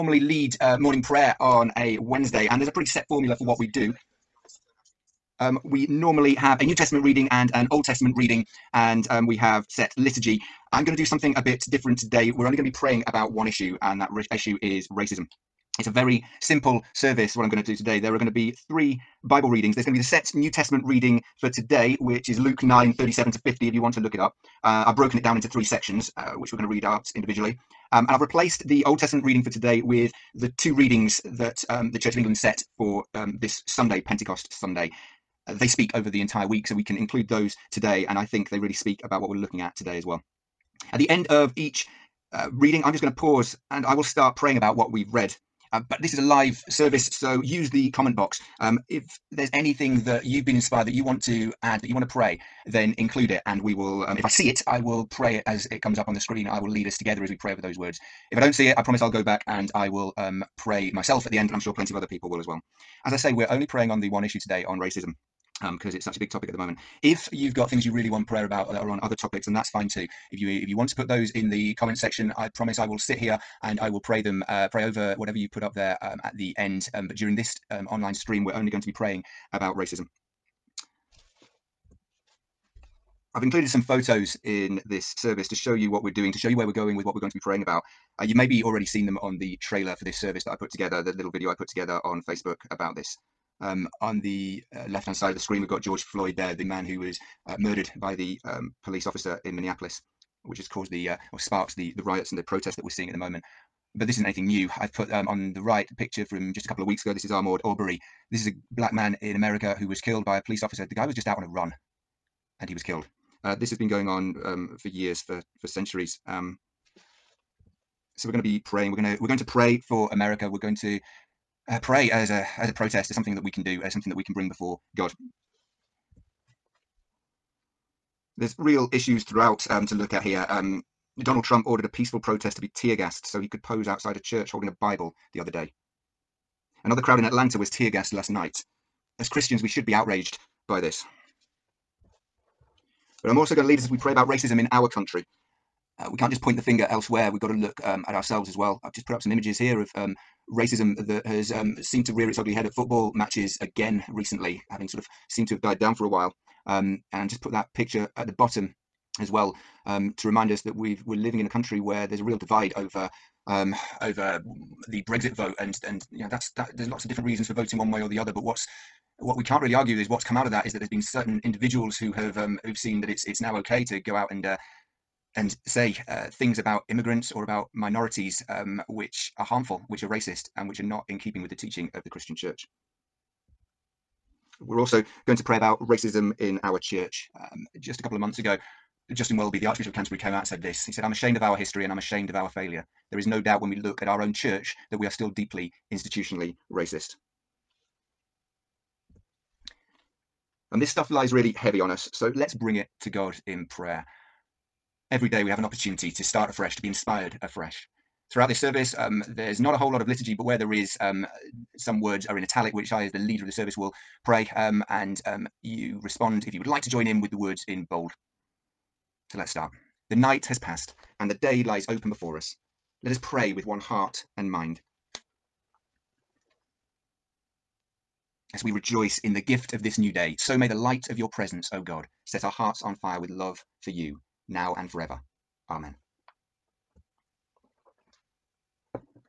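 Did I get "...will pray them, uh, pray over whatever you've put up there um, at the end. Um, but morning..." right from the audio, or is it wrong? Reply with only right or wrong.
wrong.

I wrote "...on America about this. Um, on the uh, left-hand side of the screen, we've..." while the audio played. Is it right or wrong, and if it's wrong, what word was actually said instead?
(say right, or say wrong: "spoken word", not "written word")
wrong: "Facebook", not "America".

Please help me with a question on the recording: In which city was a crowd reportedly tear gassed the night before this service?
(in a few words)
Atlanta.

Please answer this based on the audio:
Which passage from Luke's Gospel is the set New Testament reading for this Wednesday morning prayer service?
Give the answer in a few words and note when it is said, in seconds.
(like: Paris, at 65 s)
Luke 9 37 to 50, at 22 s.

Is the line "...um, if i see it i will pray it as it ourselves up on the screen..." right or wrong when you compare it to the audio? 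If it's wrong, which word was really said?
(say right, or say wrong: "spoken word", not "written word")
wrong: "comes", not "ourselves".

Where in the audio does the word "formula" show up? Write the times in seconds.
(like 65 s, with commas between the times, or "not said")
3 s.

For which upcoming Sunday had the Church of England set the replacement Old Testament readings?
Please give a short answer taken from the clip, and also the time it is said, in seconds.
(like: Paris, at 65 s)
Pentecost Sunday, at 34 s.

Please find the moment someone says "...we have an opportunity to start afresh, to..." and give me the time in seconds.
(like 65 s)
205 s.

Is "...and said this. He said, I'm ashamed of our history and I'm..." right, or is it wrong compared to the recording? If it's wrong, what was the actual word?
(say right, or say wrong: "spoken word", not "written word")
right.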